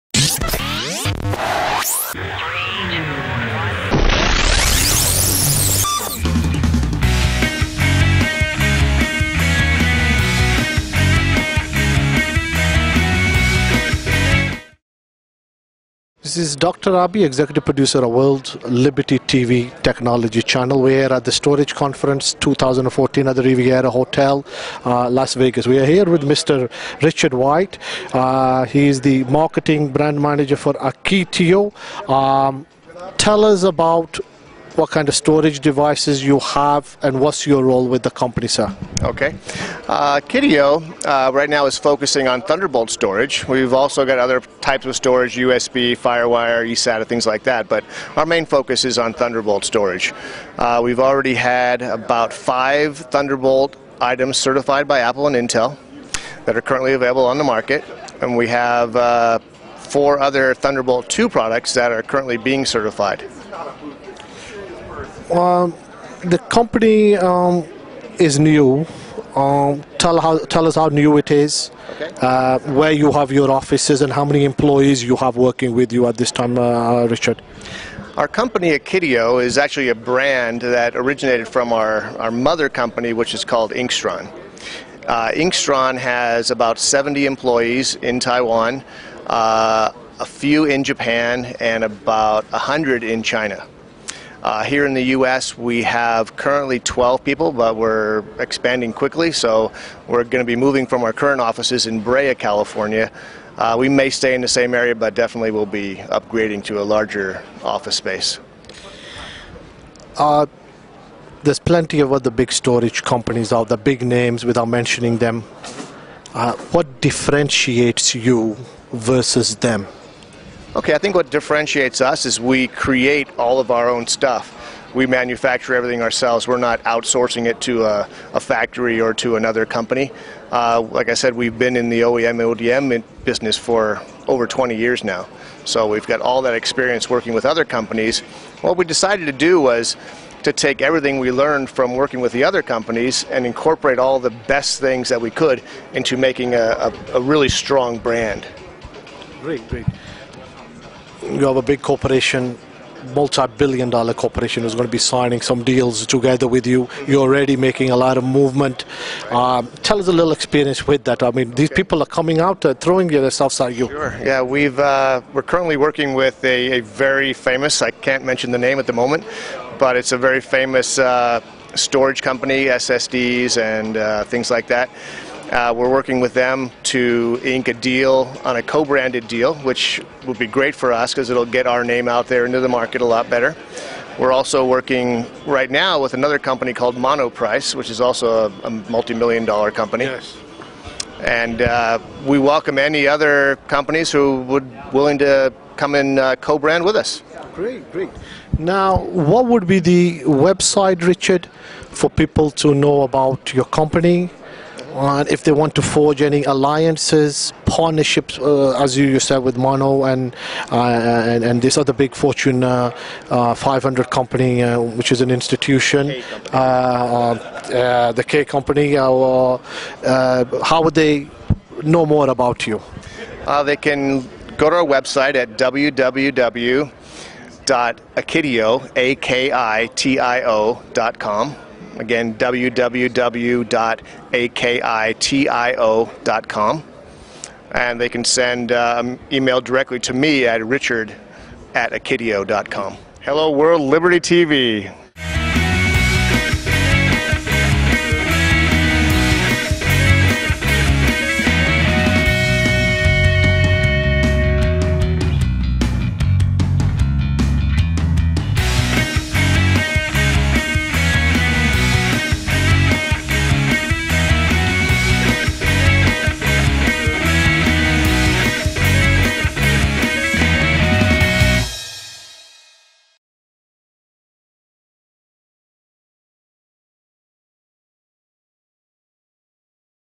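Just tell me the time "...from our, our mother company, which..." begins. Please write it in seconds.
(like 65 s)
81 s.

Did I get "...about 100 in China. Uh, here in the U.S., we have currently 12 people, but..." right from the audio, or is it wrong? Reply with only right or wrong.
right.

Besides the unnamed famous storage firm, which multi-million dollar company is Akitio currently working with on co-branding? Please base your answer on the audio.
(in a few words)
Monoprice.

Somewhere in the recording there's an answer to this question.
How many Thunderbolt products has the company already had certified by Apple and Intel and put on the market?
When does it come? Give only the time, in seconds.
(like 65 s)
52 s.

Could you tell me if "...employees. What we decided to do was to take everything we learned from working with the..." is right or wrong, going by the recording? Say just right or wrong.
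wrong.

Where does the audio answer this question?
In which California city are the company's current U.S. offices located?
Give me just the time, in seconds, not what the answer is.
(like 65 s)
101 s.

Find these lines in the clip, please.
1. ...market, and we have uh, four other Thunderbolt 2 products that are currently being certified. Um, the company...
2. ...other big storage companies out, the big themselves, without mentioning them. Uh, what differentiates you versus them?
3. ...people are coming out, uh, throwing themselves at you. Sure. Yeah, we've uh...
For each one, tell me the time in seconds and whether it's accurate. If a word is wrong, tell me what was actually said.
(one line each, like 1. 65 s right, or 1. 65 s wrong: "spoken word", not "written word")
1. 57 s right
2. 112 s wrong: "names", not "themselves"
3. 161 s right.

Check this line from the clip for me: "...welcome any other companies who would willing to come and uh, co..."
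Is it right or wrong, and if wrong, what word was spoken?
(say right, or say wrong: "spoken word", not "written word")
right.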